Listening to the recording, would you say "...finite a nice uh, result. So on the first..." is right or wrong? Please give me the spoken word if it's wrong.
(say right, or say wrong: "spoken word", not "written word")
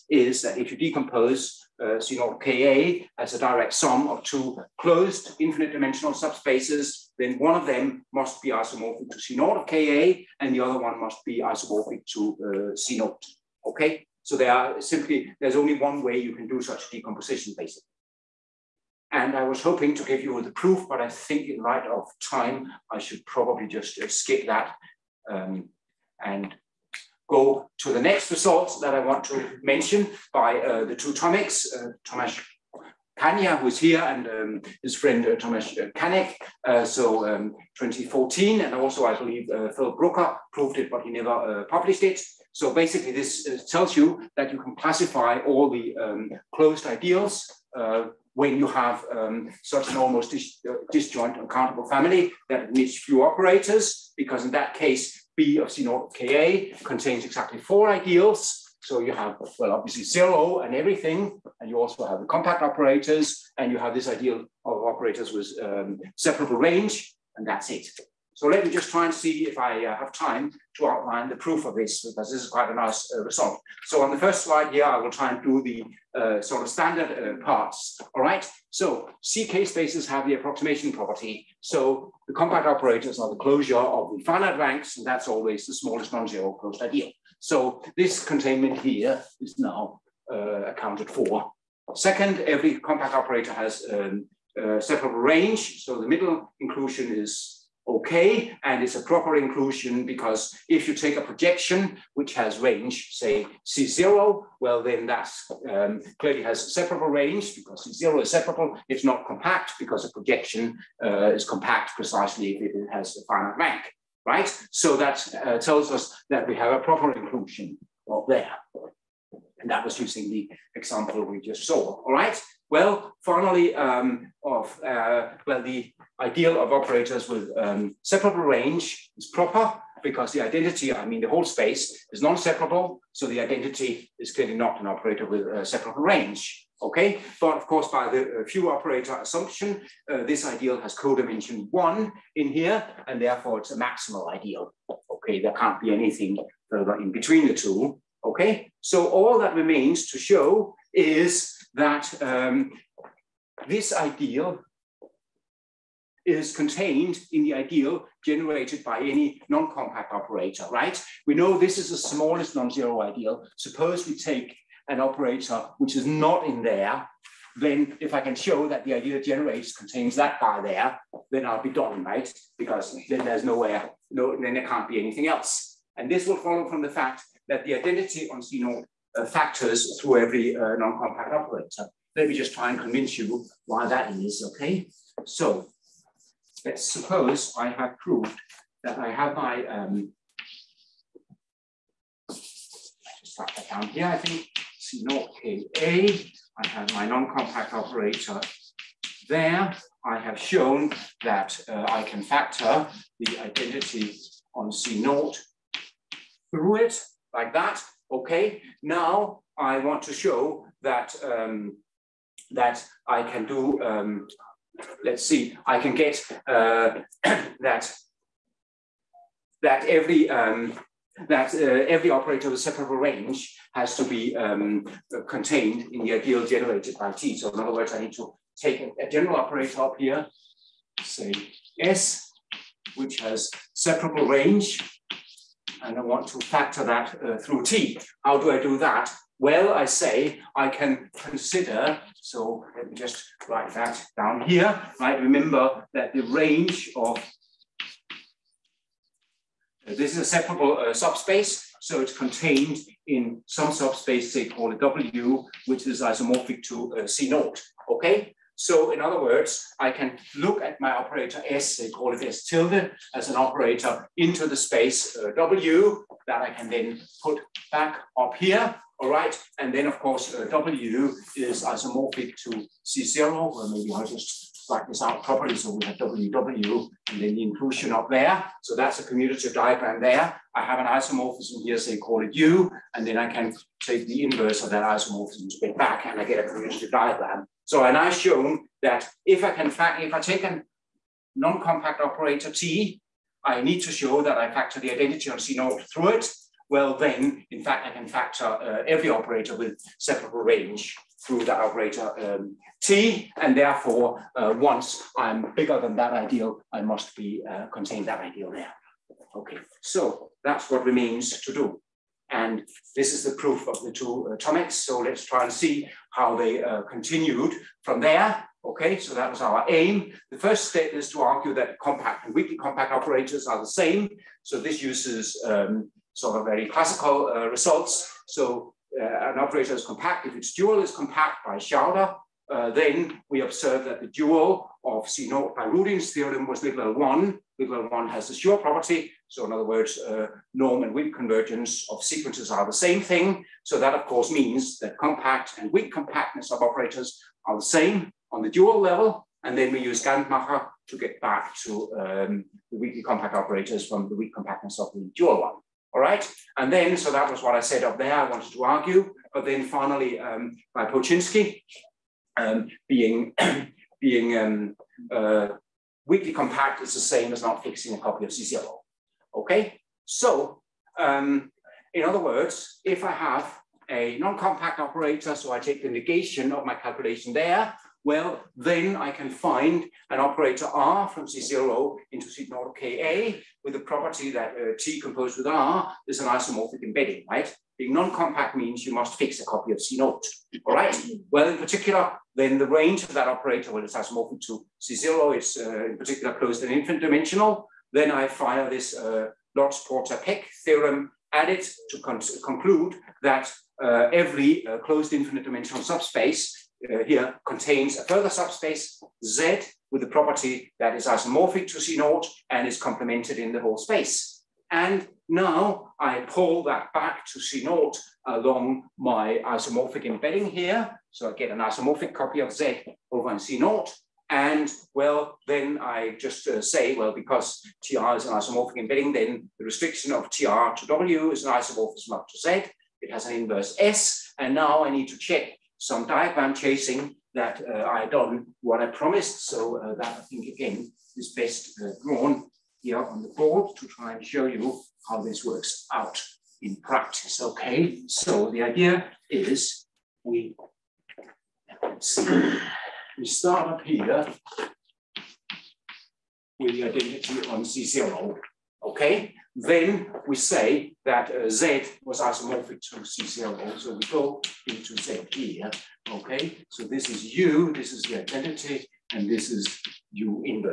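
wrong: "quite", not "finite".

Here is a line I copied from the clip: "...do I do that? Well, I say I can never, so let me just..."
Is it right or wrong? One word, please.
wrong.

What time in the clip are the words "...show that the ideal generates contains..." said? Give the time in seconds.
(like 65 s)
168 s.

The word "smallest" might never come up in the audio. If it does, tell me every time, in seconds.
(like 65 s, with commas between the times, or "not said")
85 s, 161 s.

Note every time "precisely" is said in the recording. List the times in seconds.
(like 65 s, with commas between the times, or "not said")
111 s.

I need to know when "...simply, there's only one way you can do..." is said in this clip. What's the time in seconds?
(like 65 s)
14 s.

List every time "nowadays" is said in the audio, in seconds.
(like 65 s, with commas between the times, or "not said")
not said.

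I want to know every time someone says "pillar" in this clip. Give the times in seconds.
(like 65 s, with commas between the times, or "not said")
not said.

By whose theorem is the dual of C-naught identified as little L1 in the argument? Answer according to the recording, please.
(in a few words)
Rudin.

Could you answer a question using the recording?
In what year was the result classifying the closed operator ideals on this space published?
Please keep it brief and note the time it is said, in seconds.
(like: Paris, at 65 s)
2014, at 37 s.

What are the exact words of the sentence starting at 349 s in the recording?
And then we use Gantmacher to get back to um, the weakly compact operators from the weak compactness of the dual one.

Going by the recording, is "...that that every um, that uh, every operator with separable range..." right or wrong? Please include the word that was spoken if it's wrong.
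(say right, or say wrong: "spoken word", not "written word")
right.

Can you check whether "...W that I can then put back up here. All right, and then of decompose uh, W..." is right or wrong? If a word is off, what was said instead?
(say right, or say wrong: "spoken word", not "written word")
wrong: "course", not "decompose".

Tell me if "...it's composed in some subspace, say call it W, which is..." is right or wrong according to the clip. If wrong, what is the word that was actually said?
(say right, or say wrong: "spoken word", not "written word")
wrong: "contained", not "composed".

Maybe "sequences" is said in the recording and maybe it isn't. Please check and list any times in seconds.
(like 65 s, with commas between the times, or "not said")
342 s.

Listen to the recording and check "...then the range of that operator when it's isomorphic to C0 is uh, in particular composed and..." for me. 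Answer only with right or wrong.
wrong.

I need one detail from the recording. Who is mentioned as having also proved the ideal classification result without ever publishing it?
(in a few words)
Phil Brooker.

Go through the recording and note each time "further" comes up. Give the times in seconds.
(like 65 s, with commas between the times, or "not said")
146 s, 408 s.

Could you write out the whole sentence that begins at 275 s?
So we have WW and then the inclusion up there.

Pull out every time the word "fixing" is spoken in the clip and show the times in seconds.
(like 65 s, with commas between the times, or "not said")
367 s.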